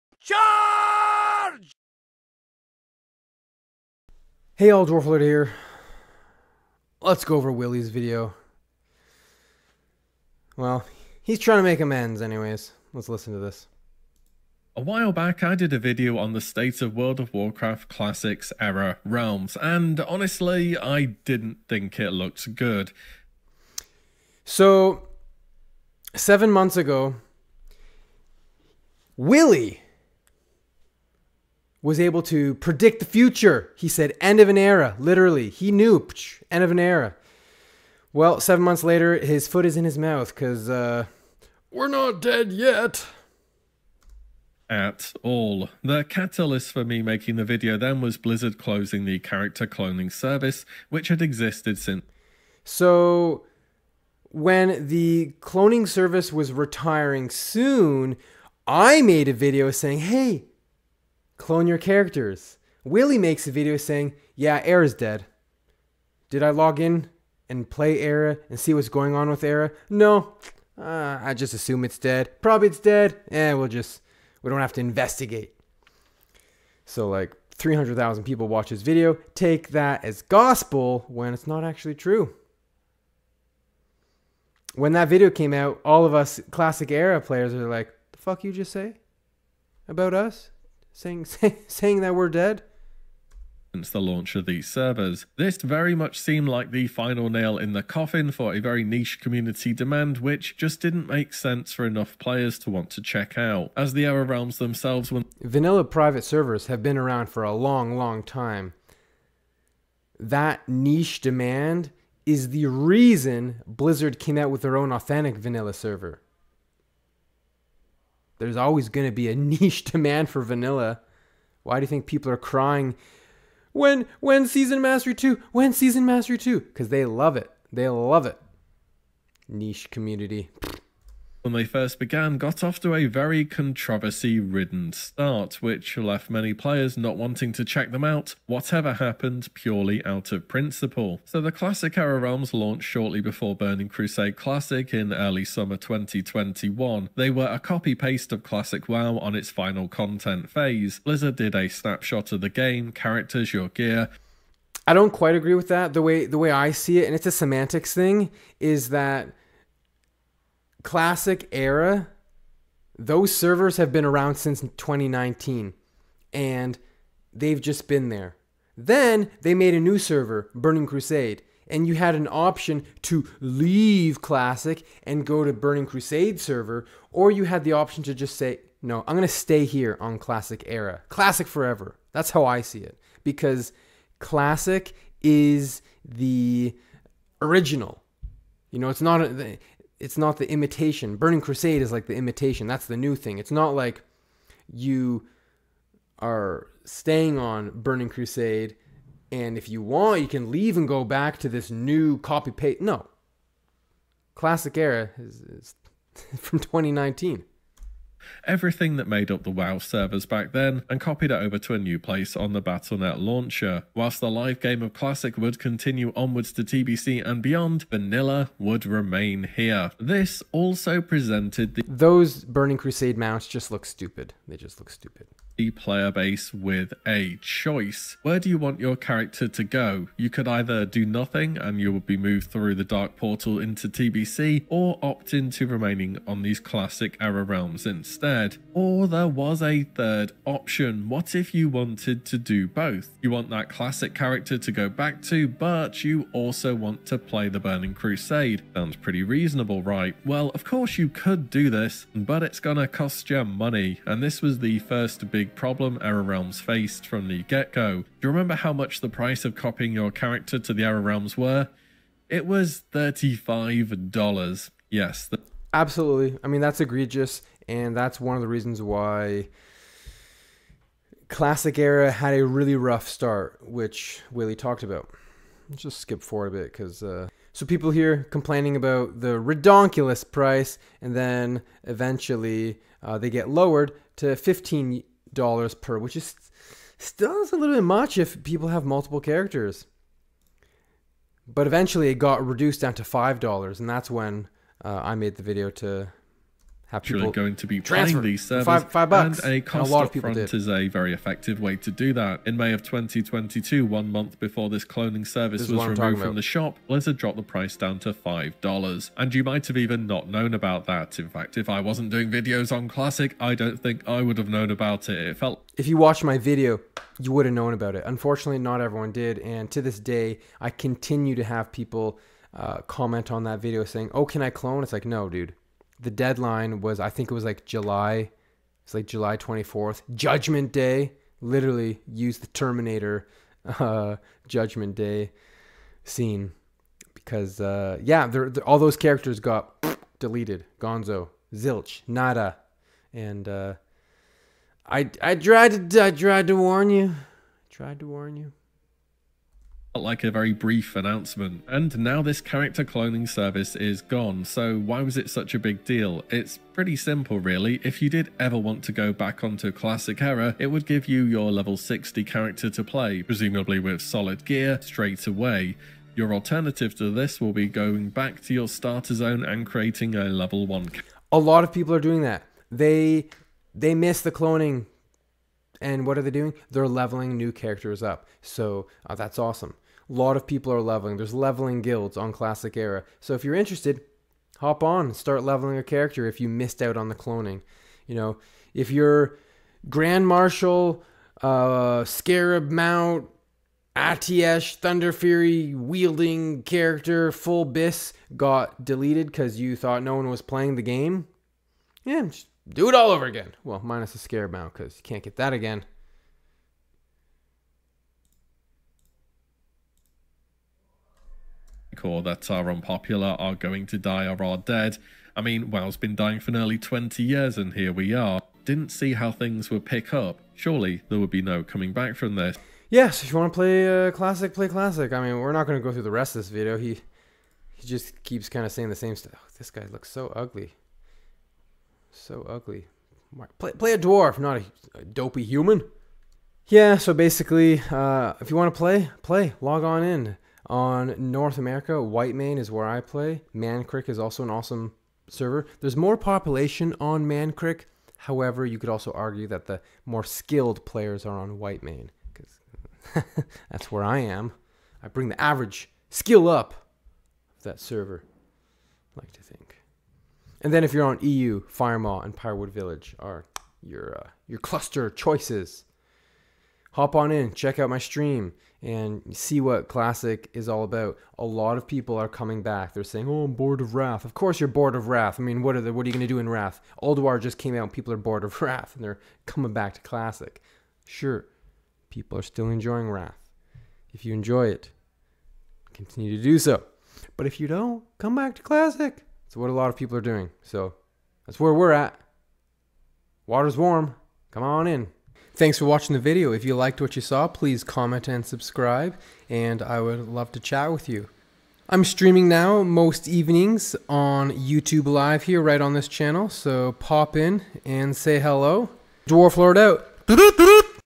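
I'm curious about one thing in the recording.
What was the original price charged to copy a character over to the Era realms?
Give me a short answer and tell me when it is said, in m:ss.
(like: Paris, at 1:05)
$35, at 4:22.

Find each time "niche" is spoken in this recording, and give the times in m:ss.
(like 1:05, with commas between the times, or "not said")
1:38, 1:50, 1:59, 2:09.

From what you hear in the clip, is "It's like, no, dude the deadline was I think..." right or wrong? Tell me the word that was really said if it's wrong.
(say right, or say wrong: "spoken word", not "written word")
right.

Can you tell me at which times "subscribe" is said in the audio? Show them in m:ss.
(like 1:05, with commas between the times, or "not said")
8:18.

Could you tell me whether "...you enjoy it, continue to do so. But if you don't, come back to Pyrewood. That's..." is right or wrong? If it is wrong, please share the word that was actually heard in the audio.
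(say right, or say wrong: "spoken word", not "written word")
wrong: "Classic", not "Pyrewood".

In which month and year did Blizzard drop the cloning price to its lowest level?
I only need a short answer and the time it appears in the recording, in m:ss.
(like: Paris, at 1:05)
May 2022, at 5:02.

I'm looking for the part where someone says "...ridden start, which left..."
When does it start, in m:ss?
2:14.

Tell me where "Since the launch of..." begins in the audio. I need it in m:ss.
1:33.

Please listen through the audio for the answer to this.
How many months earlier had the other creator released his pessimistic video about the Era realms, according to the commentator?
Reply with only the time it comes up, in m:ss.
0:26.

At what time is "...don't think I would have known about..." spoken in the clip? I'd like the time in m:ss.
5:13.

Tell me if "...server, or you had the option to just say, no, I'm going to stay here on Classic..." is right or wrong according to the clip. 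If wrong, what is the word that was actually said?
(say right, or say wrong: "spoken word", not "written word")
right.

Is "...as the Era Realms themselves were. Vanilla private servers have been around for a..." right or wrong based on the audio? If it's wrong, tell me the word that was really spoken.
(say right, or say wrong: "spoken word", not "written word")
right.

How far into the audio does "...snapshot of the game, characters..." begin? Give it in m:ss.
2:31.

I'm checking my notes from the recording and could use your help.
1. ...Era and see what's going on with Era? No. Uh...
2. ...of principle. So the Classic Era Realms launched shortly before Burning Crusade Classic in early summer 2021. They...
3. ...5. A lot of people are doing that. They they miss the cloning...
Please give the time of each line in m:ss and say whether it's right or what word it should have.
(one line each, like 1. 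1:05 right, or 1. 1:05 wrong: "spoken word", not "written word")
1. 1:07 right
2. 2:20 right
3. 6:10 wrong: "1", not "5".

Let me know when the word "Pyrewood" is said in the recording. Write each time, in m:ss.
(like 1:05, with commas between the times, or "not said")
7:42.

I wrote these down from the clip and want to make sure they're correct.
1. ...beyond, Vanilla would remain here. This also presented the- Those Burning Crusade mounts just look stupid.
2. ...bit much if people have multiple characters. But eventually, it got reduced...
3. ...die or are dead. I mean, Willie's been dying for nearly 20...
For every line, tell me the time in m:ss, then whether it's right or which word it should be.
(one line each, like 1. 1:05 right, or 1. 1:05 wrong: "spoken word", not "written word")
1. 3:37 right
2. 4:47 right
3. 6:53 wrong: "WoW", not "Willie".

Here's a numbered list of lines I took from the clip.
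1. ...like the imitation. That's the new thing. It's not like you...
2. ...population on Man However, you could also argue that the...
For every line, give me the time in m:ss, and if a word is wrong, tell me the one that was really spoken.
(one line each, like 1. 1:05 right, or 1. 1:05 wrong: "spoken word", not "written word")
1. 3:11 right
2. 7:26 right.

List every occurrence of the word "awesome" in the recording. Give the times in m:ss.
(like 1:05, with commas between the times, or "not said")
6:19, 7:24.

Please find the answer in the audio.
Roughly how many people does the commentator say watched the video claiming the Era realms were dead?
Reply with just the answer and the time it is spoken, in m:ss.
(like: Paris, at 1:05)
300,000, at 1:17.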